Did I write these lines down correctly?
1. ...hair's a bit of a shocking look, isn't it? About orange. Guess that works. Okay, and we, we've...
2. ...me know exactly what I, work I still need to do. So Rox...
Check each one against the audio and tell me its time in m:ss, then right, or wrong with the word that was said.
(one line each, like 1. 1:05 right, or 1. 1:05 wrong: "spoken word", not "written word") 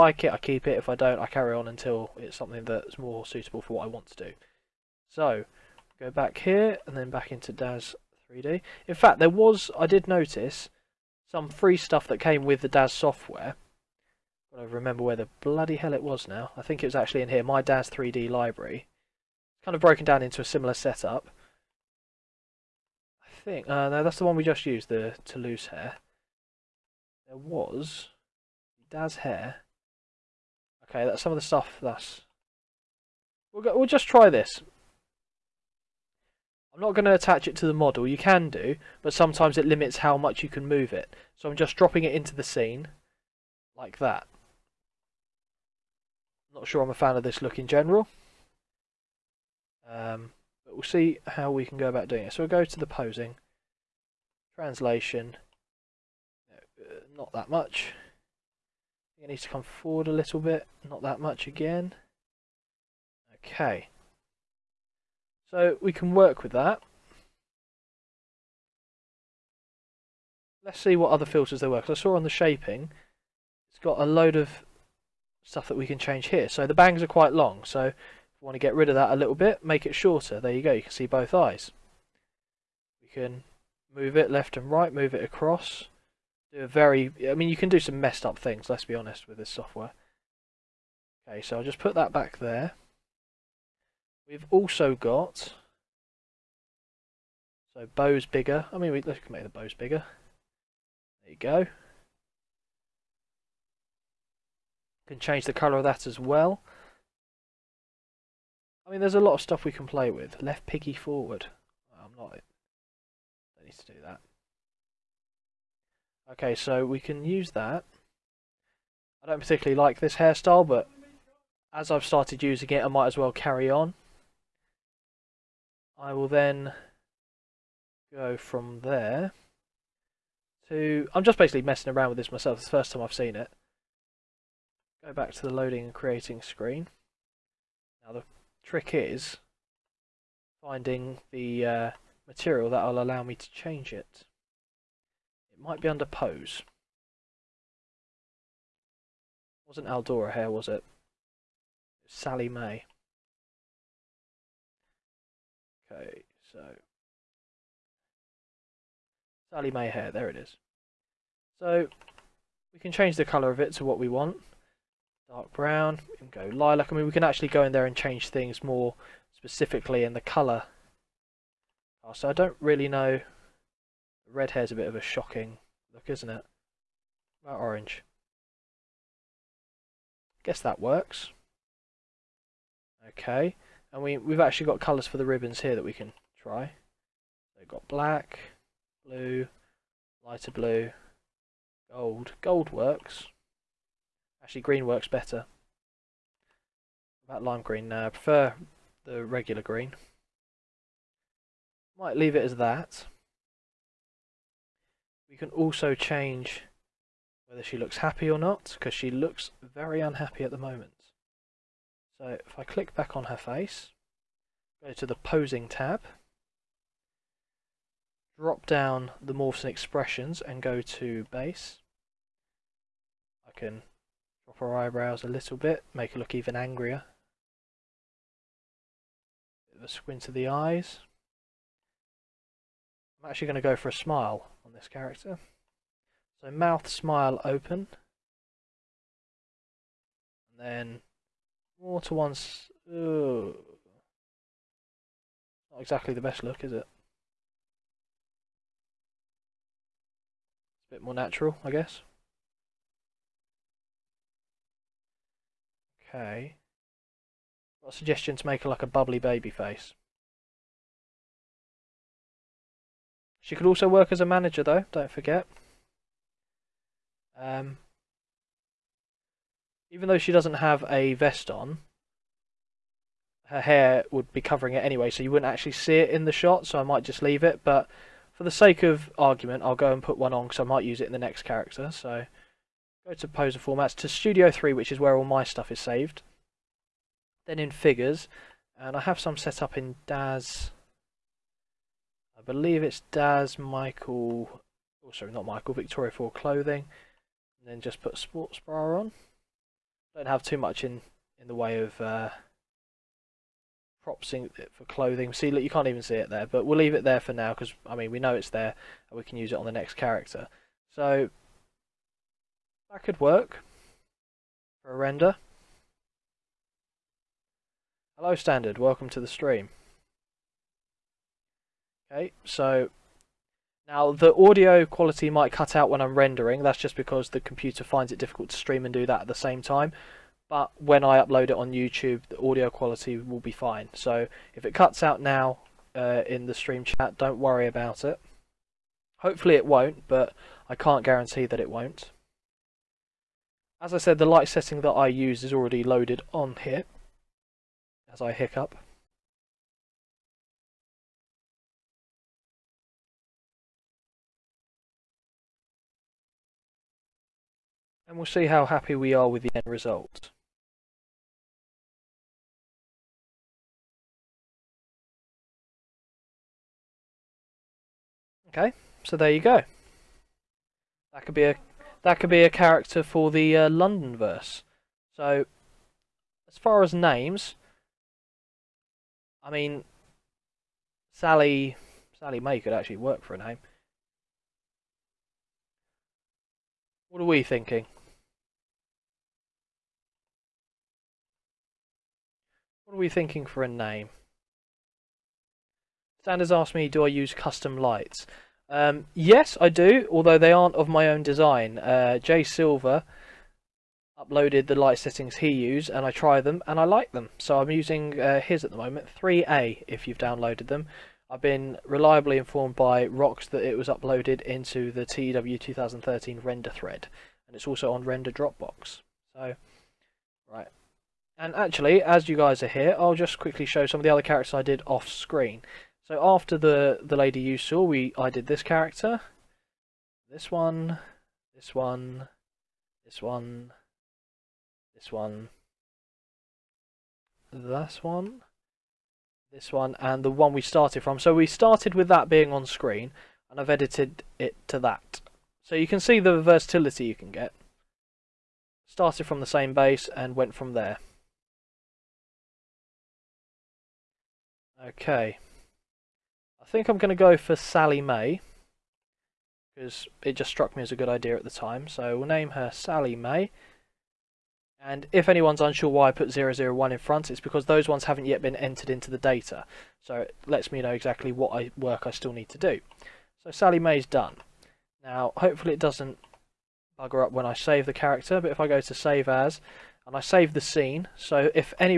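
1. 2:54 right
2. 7:50 wrong: "Sally", not "Rox".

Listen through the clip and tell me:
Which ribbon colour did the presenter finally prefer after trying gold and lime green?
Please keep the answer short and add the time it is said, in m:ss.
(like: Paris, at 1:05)
Regular green, at 3:19.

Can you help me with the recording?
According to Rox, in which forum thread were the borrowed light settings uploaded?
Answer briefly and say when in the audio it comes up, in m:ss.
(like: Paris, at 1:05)
TW 2013 render thread, at 6:55.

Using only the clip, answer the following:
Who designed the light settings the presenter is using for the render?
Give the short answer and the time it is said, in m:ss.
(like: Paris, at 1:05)
Jay Silver, at 6:42.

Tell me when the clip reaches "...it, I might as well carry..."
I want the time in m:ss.
2:02.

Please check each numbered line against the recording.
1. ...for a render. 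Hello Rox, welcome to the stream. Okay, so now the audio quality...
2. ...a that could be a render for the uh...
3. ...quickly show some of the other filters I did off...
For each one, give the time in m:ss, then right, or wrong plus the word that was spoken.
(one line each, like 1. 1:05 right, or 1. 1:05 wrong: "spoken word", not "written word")
1. 5:14 wrong: "Standard", not "Rox"
2. 6:11 wrong: "character", not "render"
3. 7:03 wrong: "characters", not "filters".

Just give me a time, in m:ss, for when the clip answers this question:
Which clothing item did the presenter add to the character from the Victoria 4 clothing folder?
4:58.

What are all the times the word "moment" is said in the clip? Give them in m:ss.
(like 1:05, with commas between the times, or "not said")
3:30, 6:48.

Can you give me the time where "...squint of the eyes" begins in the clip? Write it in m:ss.
3:49.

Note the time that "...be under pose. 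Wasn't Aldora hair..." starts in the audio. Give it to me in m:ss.
2:25.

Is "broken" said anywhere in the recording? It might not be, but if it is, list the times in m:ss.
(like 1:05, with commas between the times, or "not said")
0:19.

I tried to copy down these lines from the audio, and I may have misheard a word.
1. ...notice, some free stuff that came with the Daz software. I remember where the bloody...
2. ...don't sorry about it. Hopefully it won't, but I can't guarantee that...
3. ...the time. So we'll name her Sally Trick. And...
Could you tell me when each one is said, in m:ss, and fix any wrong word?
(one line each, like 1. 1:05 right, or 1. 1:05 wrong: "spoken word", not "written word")
1. 0:10 right
2. 5:37 wrong: "worry", not "sorry"
3. 7:41 wrong: "May", not "Trick".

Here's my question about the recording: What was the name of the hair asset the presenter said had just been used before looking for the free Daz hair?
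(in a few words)
Toulouse hair.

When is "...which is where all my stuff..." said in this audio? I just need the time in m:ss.
4:44.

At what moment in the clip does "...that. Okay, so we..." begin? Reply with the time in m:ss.
1:54.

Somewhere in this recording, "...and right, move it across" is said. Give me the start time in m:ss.
1:24.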